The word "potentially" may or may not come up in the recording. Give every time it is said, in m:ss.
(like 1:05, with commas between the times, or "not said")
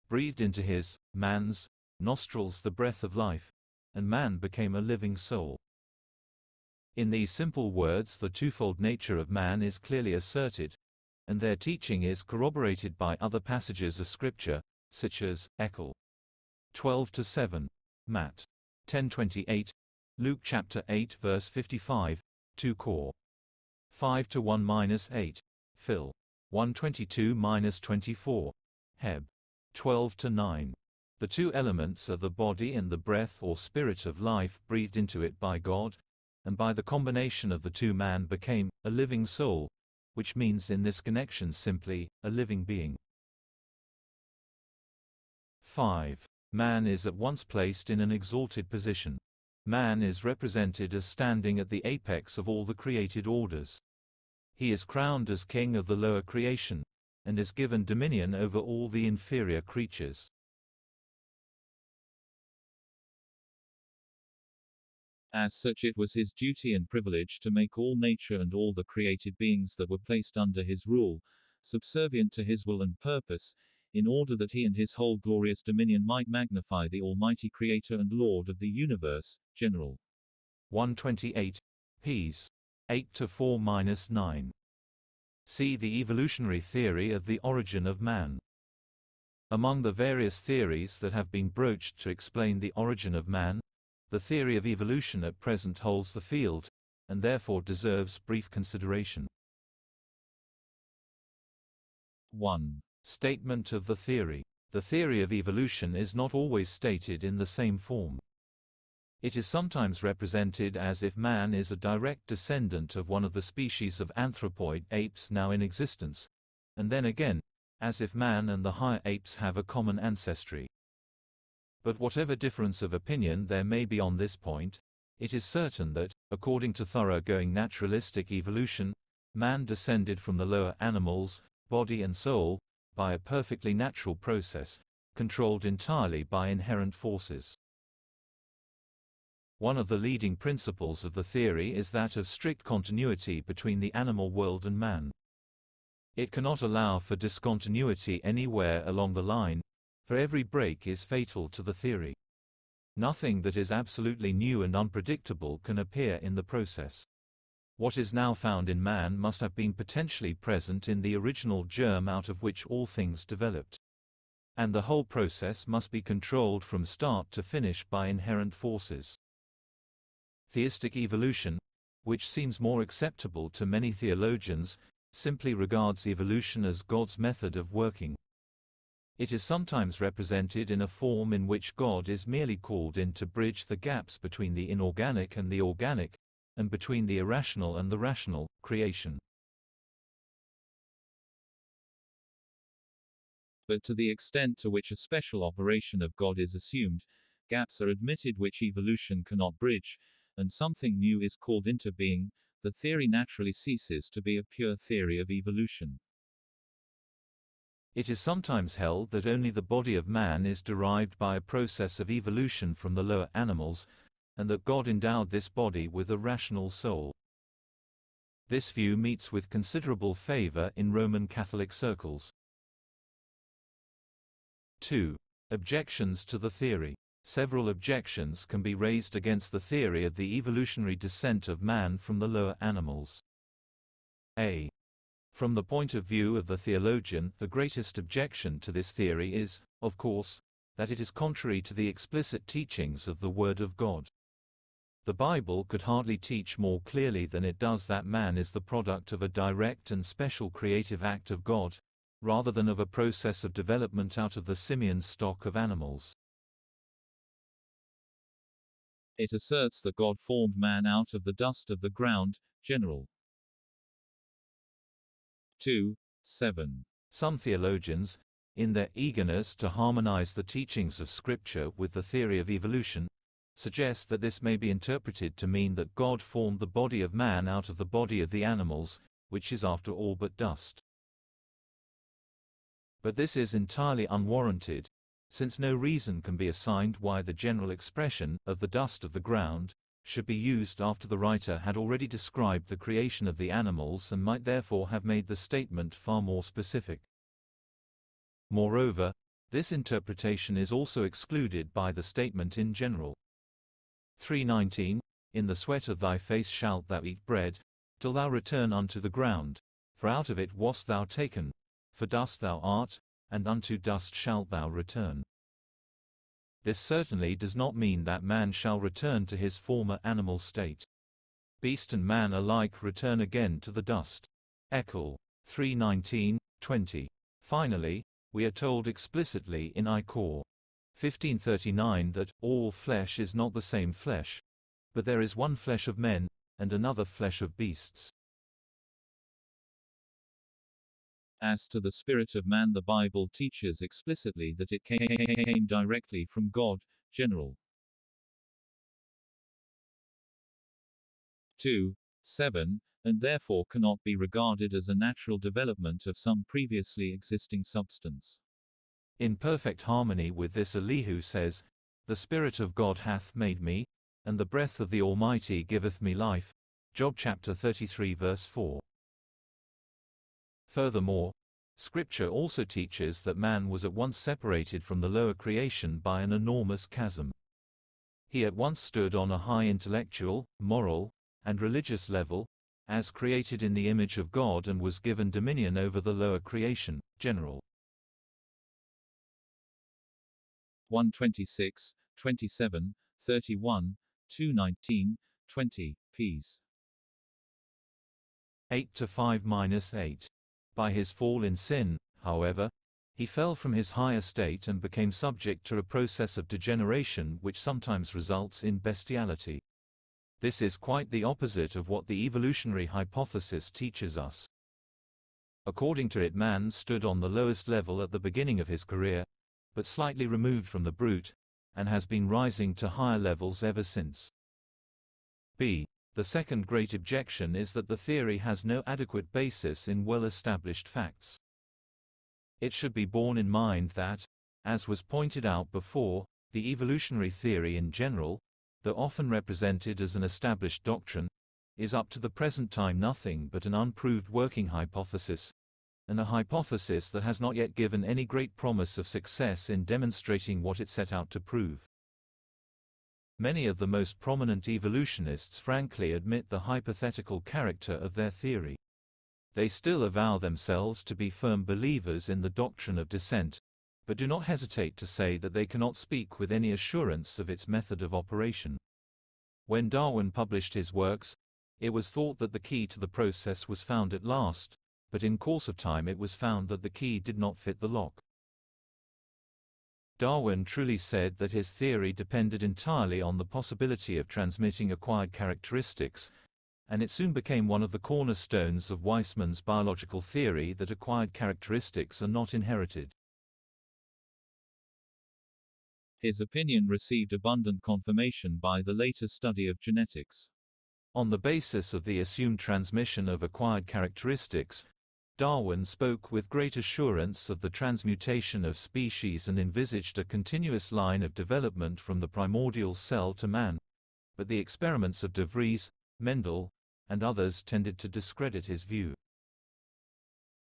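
2:39.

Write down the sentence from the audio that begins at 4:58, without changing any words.
Moreover, this interpretation is also excluded by the statement in general.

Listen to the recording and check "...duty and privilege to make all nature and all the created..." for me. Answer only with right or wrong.
right.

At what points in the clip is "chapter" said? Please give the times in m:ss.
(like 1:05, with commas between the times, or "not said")
0:20, 6:07.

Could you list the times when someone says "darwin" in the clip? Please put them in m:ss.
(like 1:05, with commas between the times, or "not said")
7:49, 8:00, 8:25.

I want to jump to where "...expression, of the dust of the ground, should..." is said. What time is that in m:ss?
4:47.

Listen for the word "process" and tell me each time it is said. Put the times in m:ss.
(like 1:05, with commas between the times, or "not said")
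2:14, 2:36, 2:45, 3:31, 4:12, 6:45, 7:53.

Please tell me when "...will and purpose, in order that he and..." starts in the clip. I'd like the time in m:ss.
1:12.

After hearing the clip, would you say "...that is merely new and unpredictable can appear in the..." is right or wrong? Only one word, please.
wrong.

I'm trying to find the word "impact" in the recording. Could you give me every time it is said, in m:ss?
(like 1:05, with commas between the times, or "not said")
not said.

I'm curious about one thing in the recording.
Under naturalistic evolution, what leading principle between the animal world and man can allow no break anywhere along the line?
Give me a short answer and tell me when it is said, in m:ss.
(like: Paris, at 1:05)
strict continuity, at 2:22.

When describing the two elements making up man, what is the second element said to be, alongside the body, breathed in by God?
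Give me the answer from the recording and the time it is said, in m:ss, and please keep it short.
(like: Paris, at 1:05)
breath or spirit of life, at 0:32.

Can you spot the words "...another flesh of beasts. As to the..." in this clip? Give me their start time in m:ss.
5:36.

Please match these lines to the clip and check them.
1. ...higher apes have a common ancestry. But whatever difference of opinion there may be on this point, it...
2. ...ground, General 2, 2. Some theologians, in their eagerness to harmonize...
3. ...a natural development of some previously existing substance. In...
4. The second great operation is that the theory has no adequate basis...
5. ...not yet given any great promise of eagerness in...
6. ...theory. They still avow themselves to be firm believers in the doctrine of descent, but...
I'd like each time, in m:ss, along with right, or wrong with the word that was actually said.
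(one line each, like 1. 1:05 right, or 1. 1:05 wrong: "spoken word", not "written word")
1. 1:58 right
2. 4:21 wrong: "7", not "2"
3. 5:54 right
4. 7:06 wrong: "objection", not "operation"
5. 7:27 wrong: "success", not "eagerness"
6. 7:38 right.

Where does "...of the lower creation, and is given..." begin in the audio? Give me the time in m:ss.
0:55.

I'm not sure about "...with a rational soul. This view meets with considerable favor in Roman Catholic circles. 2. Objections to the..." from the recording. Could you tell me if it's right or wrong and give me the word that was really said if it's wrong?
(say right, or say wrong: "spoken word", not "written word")
right.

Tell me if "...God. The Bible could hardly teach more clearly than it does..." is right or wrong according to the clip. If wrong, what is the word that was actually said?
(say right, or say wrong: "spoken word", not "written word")
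right.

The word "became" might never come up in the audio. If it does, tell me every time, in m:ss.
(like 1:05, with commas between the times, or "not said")
0:04, 0:38, 6:44, 8:07.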